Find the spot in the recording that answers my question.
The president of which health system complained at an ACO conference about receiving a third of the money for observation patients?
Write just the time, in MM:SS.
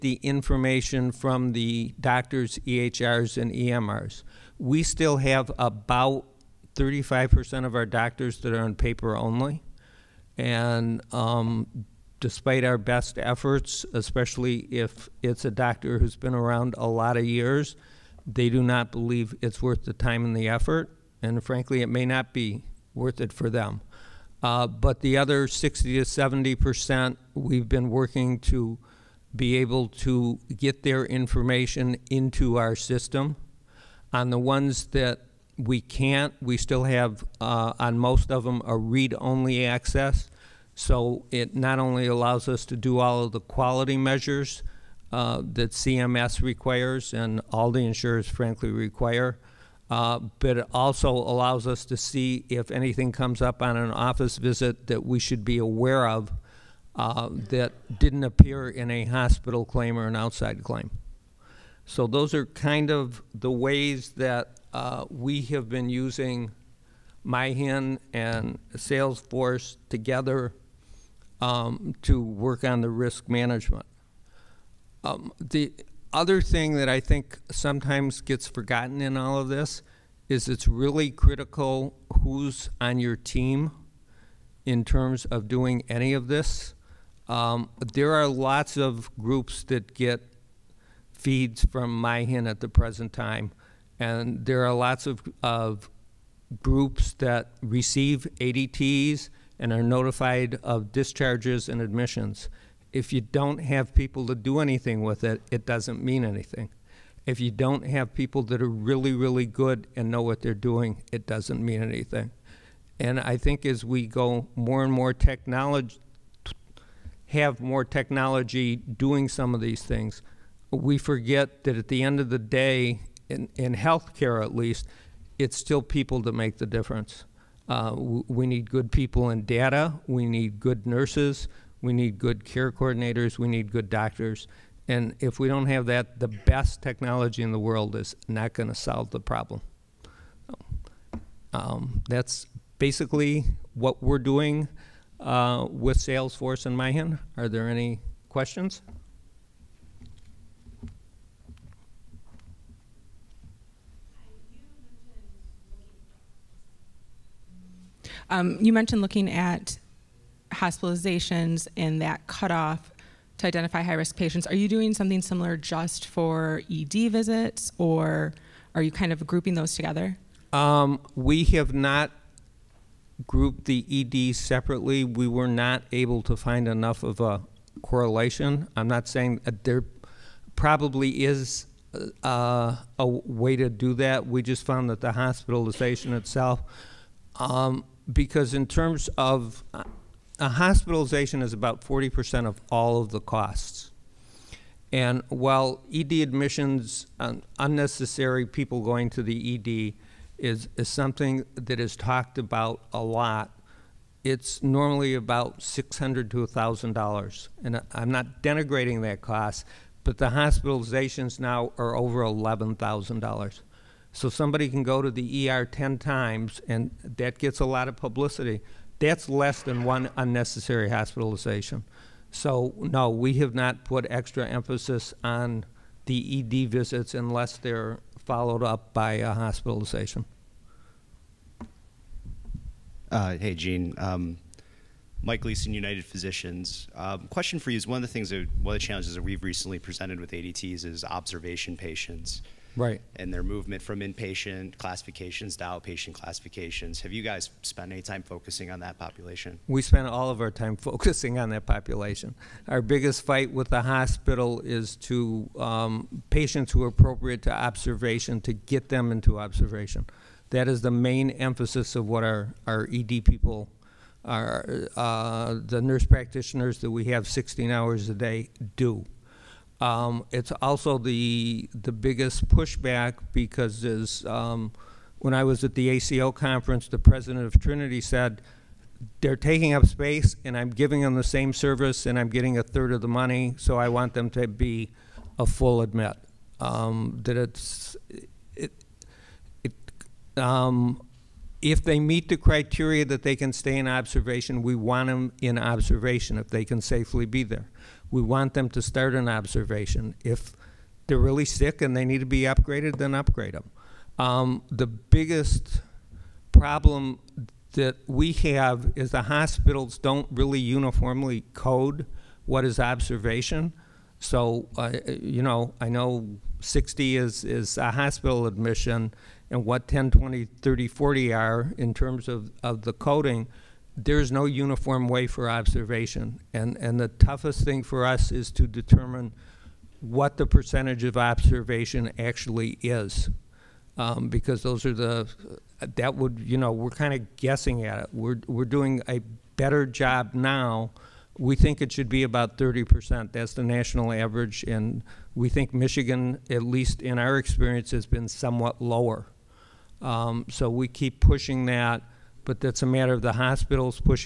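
04:37.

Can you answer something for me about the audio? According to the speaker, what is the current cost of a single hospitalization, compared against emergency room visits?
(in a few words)
over $11,000.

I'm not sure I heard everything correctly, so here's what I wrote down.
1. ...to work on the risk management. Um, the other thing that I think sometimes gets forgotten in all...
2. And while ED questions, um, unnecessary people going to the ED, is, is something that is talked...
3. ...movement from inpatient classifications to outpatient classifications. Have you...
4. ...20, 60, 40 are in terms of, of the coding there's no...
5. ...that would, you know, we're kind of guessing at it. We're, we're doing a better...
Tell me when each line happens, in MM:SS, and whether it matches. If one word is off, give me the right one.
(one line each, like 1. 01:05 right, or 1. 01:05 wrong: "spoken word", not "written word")
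1. 01:12 right
2. 03:14 wrong: "admissions", not "questions"
3. 04:03 right
4. 05:20 wrong: "30", not "60"
5. 05:35 right.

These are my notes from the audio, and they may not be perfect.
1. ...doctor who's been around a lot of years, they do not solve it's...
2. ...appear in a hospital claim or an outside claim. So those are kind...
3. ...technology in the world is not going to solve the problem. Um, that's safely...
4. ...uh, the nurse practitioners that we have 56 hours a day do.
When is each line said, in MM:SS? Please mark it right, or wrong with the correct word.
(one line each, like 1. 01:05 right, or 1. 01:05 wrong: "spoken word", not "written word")
1. 00:15 wrong: "believe", not "solve"
2. 00:58 right
3. 02:16 wrong: "basically", not "safely"
4. 04:24 wrong: "16", not "56".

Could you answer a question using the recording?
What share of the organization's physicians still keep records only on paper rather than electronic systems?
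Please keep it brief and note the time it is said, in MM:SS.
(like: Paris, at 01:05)
35%, at 00:06.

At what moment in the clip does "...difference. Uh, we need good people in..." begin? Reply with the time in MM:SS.
02:06.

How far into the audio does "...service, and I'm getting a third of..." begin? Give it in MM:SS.
04:41.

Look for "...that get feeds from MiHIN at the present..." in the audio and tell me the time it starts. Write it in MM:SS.
01:29.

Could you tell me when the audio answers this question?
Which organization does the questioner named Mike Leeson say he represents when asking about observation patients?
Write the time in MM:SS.
03:55.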